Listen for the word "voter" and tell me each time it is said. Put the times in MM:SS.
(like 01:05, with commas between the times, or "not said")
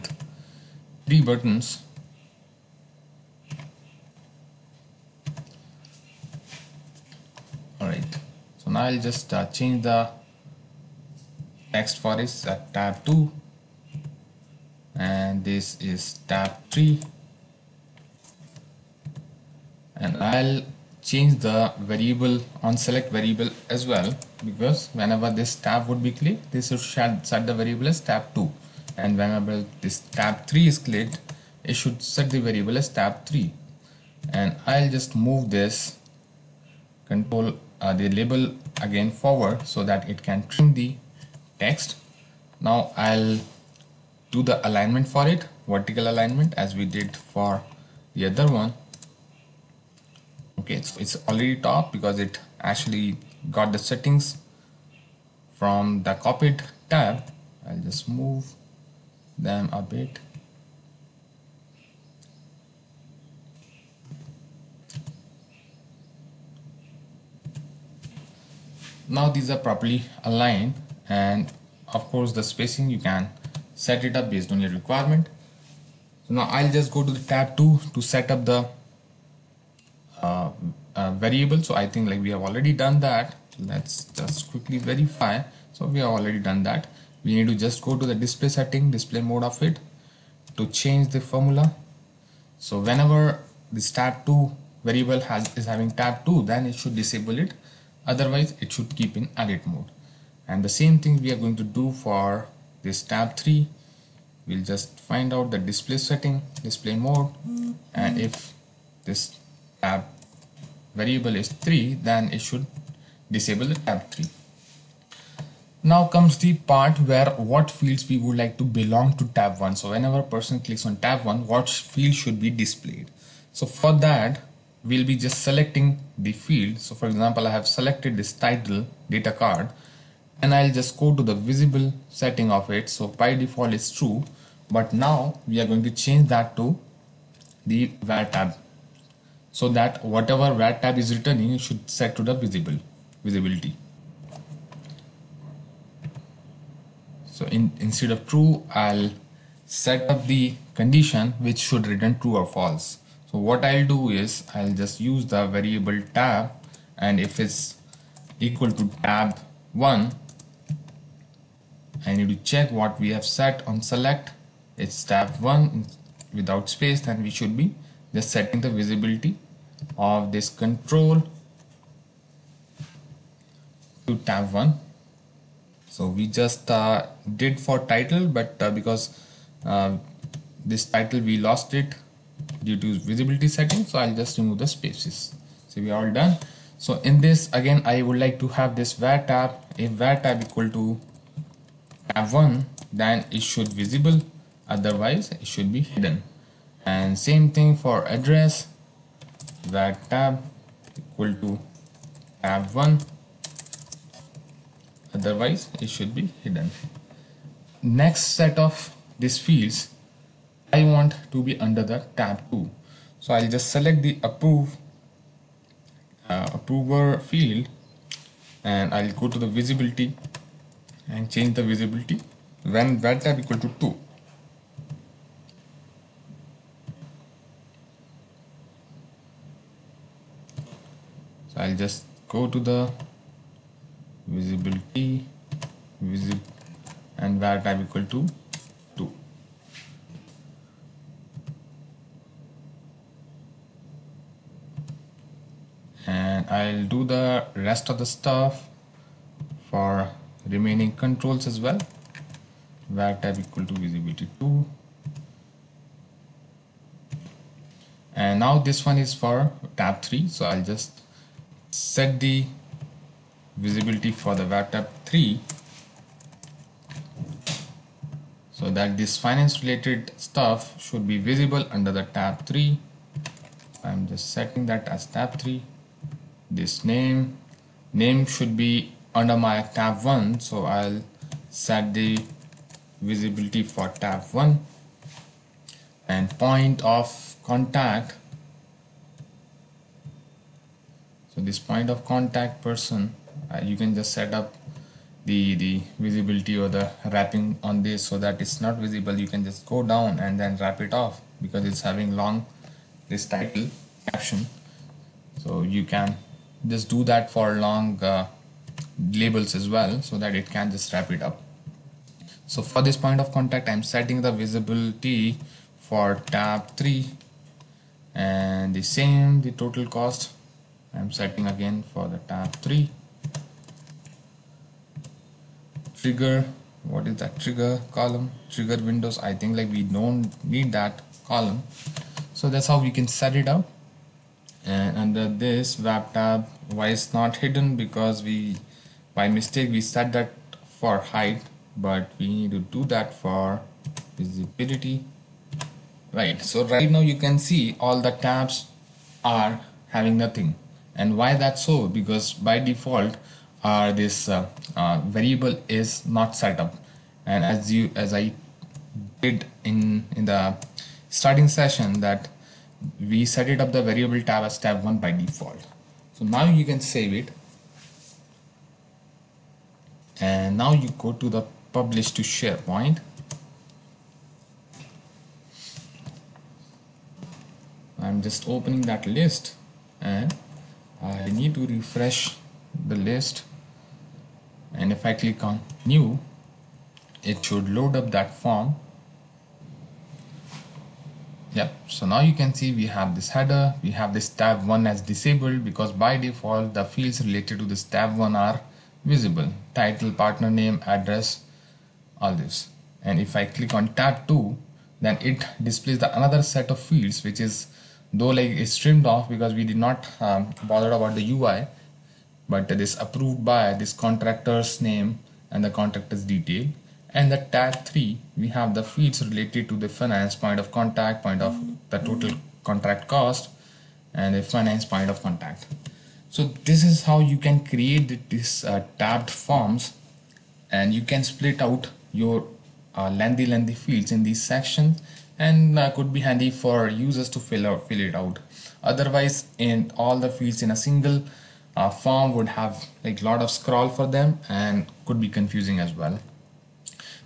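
not said.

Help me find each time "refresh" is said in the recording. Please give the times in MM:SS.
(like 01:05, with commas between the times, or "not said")
06:21.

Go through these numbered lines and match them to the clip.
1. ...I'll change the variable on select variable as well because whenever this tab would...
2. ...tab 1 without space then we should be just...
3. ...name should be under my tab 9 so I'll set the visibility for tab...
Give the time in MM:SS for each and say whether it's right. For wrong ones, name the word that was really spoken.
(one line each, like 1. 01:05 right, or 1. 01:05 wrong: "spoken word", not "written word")
1. 00:20 right
2. 02:45 right
3. 04:37 wrong: "1", not "9".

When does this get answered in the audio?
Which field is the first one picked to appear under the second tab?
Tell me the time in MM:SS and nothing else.
03:36.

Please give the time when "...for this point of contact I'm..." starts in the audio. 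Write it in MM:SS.
05:12.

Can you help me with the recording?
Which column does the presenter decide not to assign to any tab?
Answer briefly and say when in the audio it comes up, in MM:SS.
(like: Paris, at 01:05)
trigger windows, at 05:28.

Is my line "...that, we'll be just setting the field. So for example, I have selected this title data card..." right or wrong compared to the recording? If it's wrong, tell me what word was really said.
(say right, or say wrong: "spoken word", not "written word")
wrong: "selecting", not "setting".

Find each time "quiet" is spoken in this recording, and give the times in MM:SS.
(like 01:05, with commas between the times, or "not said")
not said.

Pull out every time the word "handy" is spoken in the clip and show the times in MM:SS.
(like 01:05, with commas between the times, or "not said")
07:16.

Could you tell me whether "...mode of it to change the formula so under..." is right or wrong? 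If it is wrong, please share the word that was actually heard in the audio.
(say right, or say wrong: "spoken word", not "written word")
wrong: "whenever", not "under".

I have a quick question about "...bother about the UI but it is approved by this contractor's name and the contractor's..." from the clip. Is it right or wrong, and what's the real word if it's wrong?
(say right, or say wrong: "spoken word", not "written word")
right.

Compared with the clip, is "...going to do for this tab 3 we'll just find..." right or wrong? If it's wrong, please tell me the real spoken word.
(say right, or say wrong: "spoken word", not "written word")
right.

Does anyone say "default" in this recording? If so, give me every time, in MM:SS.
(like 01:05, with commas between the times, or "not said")
02:13, 05:52, 06:05, 06:36.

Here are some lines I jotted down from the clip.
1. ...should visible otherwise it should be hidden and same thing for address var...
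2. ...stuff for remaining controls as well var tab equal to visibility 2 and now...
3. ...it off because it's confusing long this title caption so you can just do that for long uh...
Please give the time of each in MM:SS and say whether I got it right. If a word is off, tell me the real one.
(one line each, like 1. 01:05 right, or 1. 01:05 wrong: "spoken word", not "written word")
1. 03:13 right
2. 04:08 right
3. 05:00 wrong: "having", not "confusing".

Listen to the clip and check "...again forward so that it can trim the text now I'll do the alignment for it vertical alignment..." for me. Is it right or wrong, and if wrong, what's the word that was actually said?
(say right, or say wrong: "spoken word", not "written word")
right.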